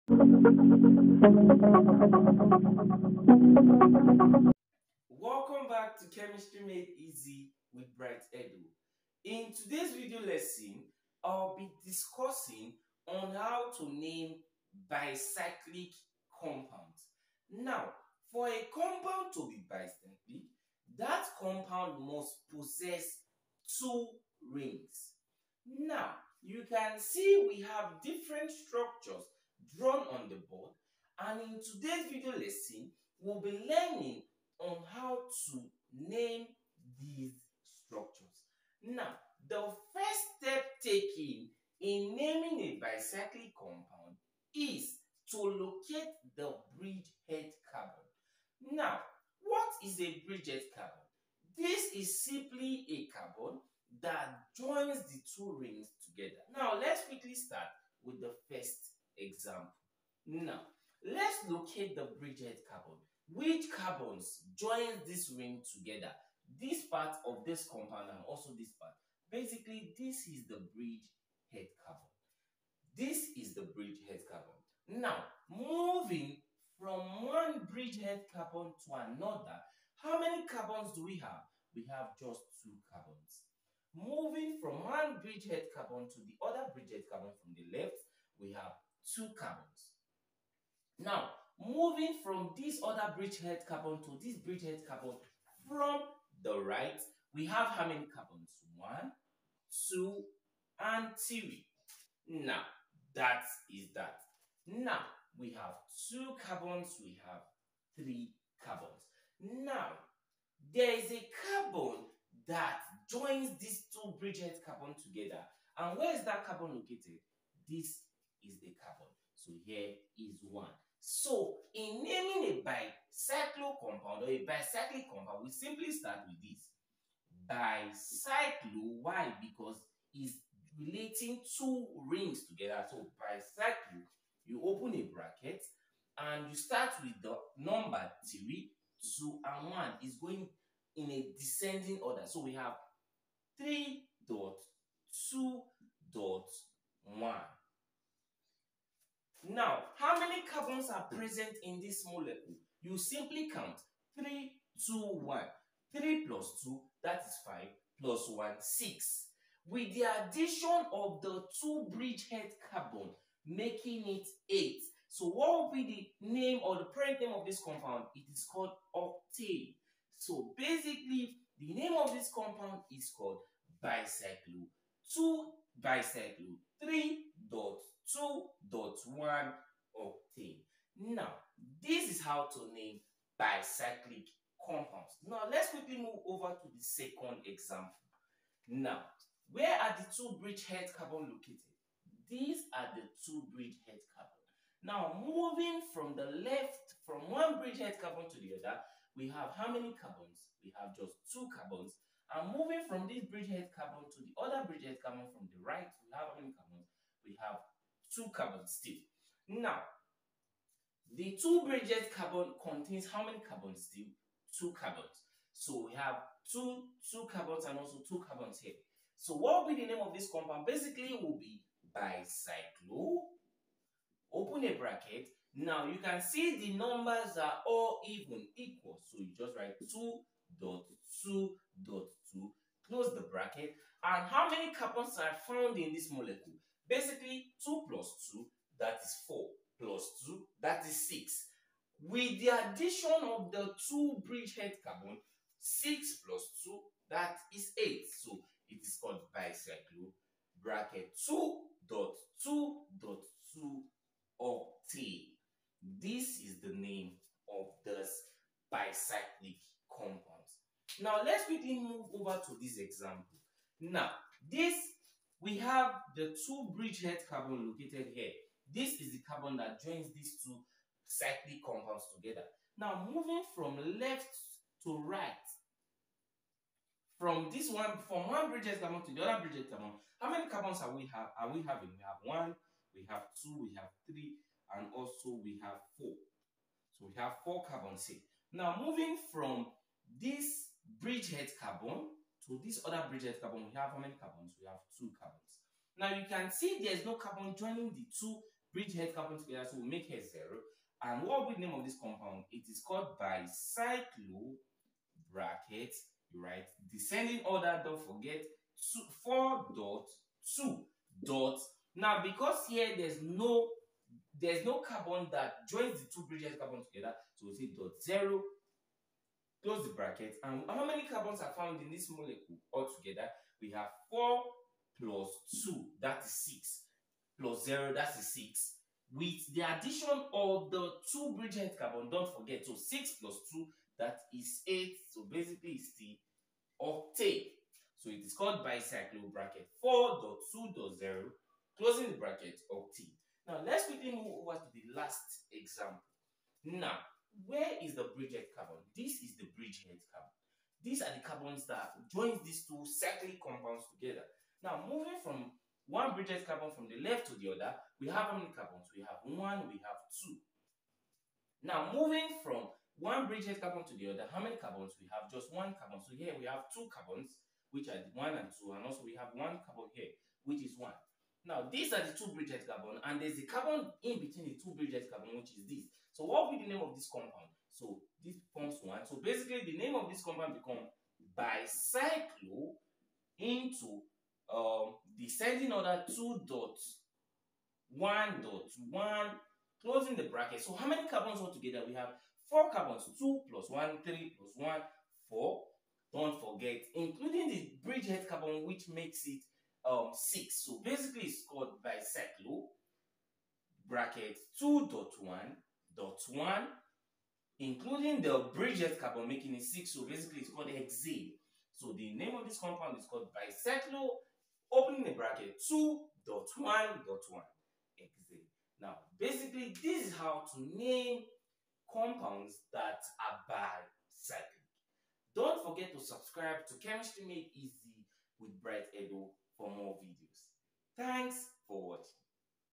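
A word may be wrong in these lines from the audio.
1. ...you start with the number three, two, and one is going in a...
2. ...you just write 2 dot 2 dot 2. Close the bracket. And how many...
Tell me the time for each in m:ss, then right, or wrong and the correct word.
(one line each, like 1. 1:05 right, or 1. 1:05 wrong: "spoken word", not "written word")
1. 2:16 right
2. 3:49 right.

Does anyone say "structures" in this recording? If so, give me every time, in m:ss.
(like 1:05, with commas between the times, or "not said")
0:28, 0:37.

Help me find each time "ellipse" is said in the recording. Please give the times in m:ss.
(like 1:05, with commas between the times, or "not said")
not said.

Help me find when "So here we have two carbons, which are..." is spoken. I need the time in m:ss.
6:06.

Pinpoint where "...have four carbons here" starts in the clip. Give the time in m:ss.
4:47.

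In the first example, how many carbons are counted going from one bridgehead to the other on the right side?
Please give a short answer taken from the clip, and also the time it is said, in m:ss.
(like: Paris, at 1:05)
3, at 1:38.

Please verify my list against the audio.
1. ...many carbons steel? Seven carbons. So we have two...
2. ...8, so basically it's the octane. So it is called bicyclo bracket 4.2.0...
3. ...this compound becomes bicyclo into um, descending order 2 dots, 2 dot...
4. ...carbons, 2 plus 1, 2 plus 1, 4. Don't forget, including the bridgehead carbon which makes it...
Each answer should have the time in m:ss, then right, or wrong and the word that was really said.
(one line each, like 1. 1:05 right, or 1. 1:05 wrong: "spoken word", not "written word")
1. 3:33 wrong: "Two", not "Seven"
2. 5:34 right
3. 6:20 wrong: "1", not "2"
4. 6:32 wrong: "3", not "2".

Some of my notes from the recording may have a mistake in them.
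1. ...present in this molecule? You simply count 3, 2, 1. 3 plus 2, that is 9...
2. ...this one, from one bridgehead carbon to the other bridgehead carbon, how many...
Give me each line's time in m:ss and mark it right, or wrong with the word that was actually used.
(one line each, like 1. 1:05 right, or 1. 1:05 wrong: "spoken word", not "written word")
1. 2:31 wrong: "5", not "9"
2. 4:37 right.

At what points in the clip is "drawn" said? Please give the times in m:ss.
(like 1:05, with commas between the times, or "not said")
0:29.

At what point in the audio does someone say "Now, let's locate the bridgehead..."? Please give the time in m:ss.
1:00.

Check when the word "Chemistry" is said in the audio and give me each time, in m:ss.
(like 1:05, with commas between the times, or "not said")
0:06, 7:06.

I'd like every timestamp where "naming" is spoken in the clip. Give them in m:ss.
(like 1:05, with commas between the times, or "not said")
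0:42, 2:02.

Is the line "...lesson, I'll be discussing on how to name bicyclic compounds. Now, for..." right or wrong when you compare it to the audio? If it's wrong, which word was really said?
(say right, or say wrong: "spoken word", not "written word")
right.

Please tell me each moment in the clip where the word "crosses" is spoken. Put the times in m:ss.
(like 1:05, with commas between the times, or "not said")
not said.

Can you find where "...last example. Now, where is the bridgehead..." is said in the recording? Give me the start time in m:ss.
5:44.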